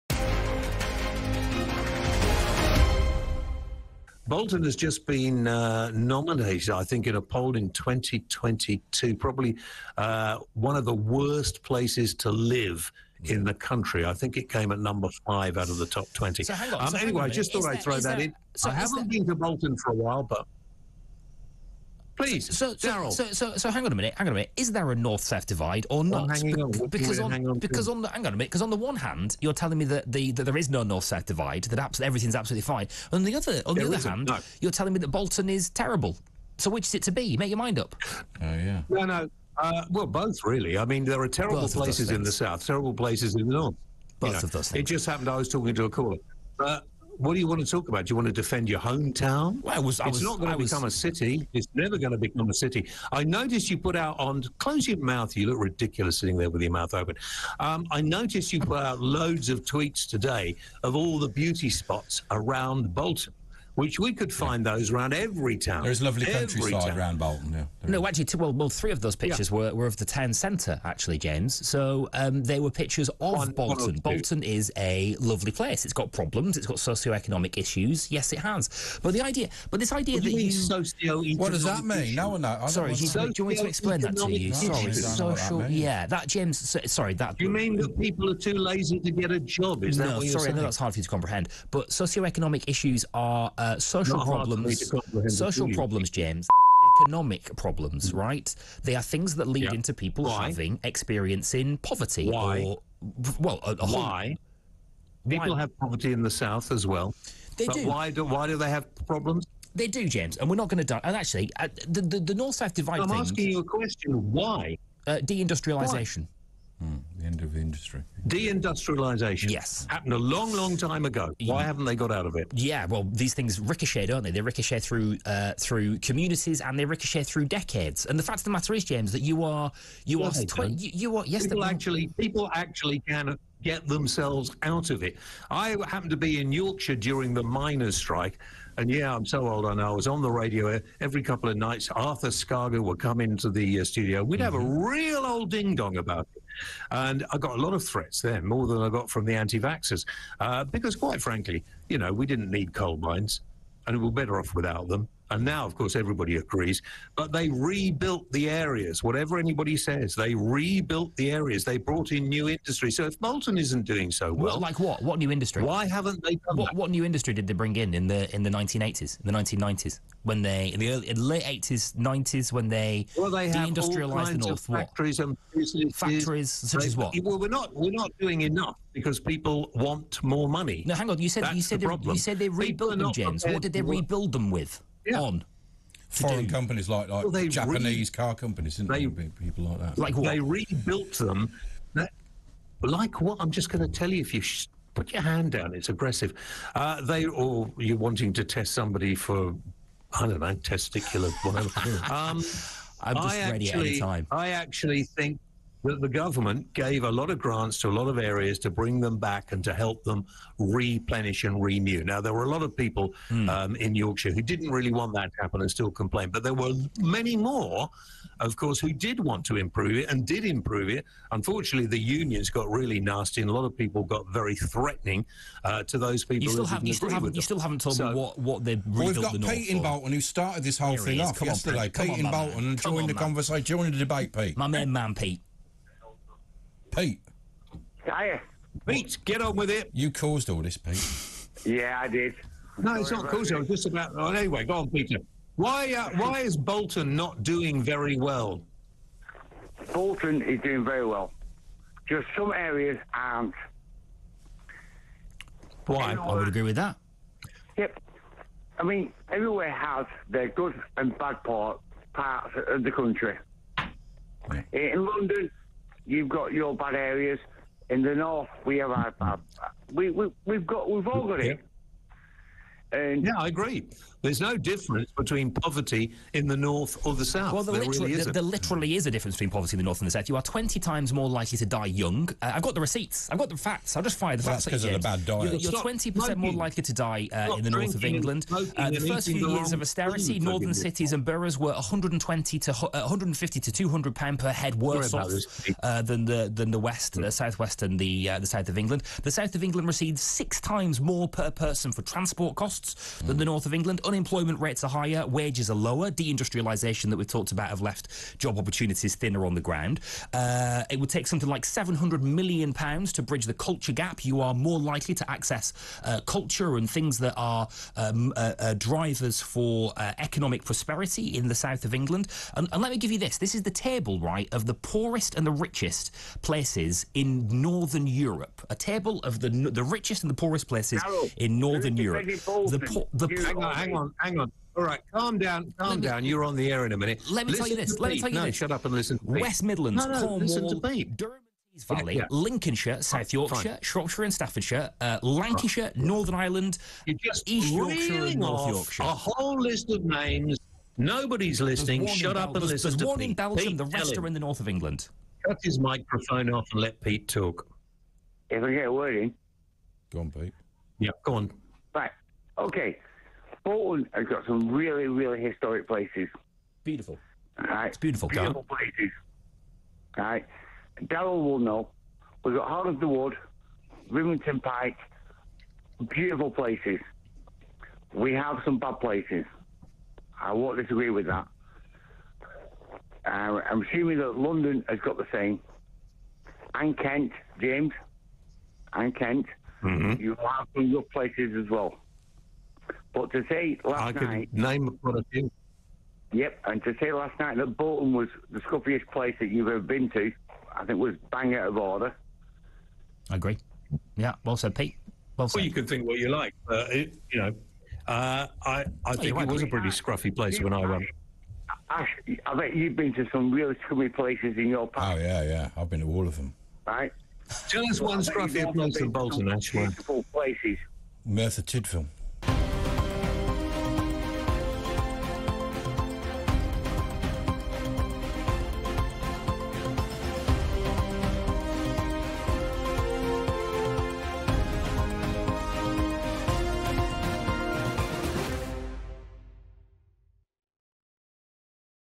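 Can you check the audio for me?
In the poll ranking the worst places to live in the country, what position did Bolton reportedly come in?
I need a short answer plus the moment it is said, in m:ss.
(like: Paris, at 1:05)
5, at 0:14.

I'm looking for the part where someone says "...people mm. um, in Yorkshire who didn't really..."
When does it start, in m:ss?
3:32.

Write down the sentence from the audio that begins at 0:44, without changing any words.
Both you know, of those things.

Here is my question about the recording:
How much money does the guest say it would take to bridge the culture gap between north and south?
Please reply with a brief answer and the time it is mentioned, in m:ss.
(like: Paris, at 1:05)
700 million pounds, at 5:11.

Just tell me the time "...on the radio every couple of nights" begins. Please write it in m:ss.
2:20.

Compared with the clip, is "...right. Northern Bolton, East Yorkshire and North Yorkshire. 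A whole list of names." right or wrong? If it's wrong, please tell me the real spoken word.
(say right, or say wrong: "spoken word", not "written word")
wrong: "Ireland", not "Bolton".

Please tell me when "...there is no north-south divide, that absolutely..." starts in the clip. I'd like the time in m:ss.
0:30.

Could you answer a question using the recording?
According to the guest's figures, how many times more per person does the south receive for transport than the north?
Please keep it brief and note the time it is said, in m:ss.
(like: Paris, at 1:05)
6, at 5:00.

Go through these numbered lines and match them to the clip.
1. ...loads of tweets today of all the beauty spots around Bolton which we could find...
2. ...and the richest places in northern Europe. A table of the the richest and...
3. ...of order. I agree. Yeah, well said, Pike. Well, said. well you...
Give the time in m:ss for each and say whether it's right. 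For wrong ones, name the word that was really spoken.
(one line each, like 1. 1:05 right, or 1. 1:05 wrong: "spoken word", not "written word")
1. 0:58 right
2. 5:25 right
3. 6:41 wrong: "Pete", not "Pike".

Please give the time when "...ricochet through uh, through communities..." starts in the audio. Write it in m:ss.
2:04.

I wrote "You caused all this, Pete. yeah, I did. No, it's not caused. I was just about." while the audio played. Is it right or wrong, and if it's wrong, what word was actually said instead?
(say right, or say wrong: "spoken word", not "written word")
right.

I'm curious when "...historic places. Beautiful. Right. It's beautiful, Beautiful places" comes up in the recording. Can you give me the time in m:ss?
6:05.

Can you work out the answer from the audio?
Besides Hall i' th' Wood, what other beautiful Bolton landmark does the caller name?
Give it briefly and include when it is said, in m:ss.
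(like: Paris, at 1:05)
Rivington Pike, at 6:14.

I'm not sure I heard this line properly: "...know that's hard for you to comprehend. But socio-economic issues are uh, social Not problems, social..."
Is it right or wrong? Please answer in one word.
right.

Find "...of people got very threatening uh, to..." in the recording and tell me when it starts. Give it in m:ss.
3:43.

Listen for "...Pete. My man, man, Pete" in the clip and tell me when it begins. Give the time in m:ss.
3:54.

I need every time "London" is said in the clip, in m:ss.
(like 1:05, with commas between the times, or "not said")
4:25, 6:24.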